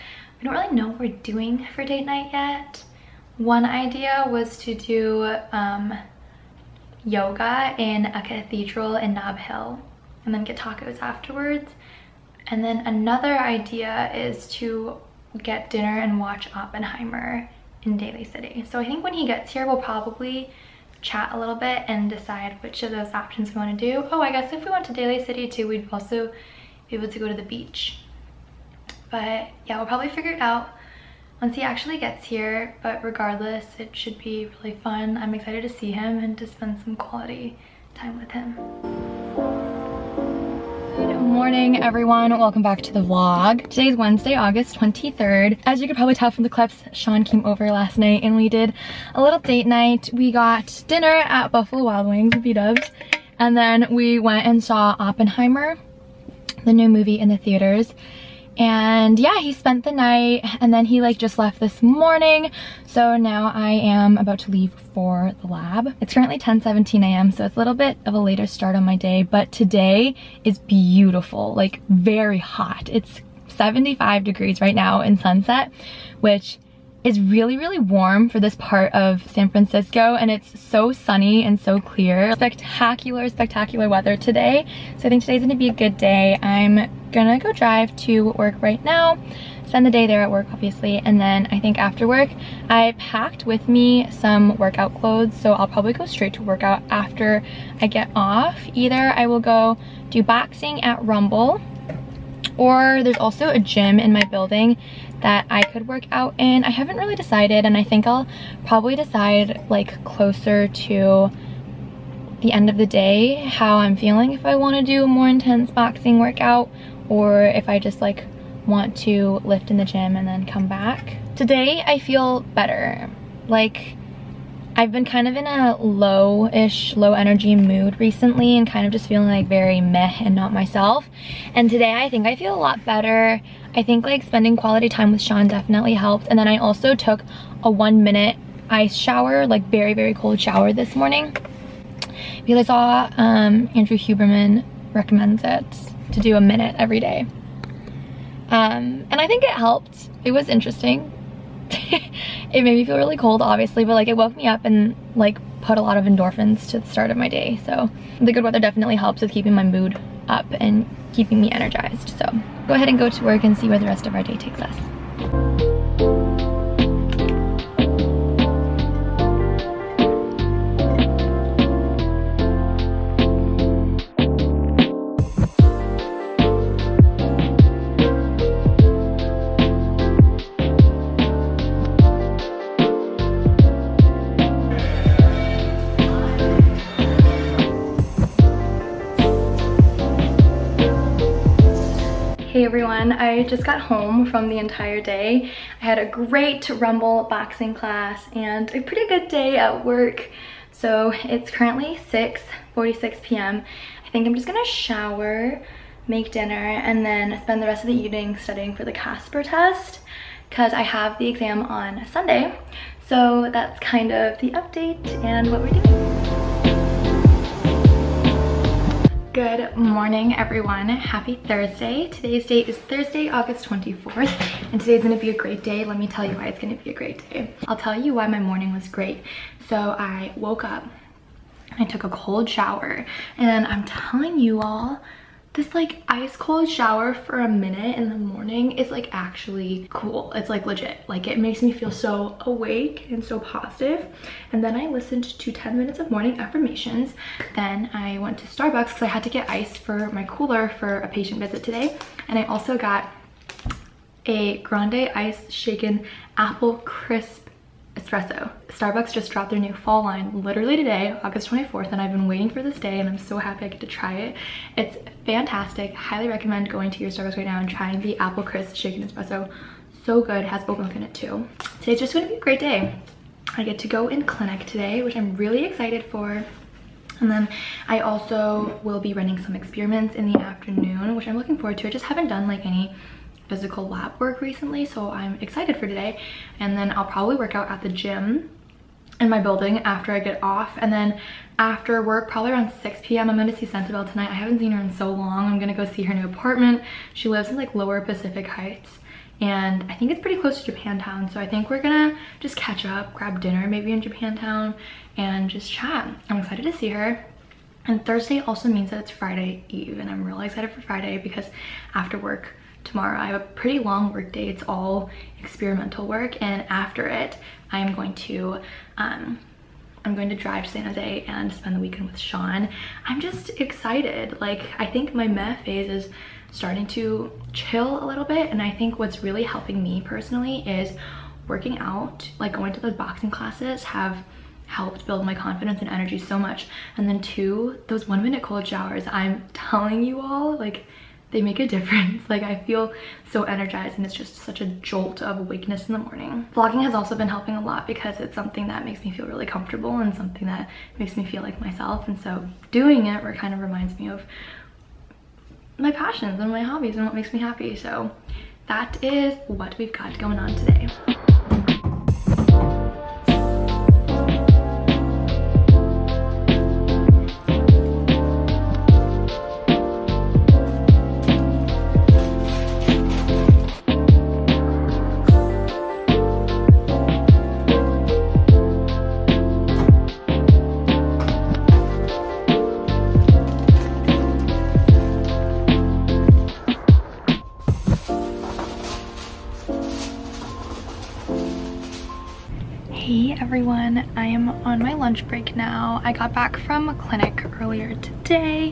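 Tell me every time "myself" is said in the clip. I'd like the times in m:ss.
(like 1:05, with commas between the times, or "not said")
2:10, 5:51.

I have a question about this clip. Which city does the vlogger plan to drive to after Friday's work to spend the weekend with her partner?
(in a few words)
San Jose.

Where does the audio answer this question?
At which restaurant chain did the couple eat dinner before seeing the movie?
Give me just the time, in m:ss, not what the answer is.
0:51.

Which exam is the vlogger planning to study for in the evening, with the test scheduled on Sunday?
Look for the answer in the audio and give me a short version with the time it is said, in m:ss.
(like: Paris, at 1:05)
Casper, at 3:28.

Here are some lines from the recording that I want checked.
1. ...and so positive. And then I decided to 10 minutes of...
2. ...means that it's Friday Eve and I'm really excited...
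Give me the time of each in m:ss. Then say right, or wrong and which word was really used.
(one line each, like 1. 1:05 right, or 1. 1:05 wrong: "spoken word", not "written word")
1. 4:03 wrong: "listened", not "decided"
2. 5:08 right.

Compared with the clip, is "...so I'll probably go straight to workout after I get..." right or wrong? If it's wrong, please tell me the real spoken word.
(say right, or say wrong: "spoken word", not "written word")
right.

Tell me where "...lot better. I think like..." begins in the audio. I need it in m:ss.
2:12.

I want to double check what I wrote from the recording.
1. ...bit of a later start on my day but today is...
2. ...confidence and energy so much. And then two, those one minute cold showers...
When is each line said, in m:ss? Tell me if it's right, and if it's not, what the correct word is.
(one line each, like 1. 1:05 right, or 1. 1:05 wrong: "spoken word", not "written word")
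1. 1:07 right
2. 5:35 right.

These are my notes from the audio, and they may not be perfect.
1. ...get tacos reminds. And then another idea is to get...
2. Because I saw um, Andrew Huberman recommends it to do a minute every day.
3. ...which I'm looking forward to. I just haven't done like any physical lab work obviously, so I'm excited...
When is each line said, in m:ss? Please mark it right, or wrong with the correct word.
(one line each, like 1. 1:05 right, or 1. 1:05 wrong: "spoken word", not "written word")
1. 0:10 wrong: "afterwards", not "reminds"
2. 2:22 right
3. 4:41 wrong: "recently", not "obviously".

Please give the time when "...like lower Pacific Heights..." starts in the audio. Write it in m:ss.
4:57.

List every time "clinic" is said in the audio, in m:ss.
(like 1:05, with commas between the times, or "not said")
4:34, 6:36.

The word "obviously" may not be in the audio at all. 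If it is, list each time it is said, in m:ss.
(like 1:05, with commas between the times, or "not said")
1:30, 2:33.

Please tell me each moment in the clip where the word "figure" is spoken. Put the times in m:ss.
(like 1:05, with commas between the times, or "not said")
0:30.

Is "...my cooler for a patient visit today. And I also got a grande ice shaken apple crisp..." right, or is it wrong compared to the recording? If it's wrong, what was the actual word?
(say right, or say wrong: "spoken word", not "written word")
right.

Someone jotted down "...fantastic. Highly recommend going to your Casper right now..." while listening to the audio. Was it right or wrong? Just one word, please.
wrong.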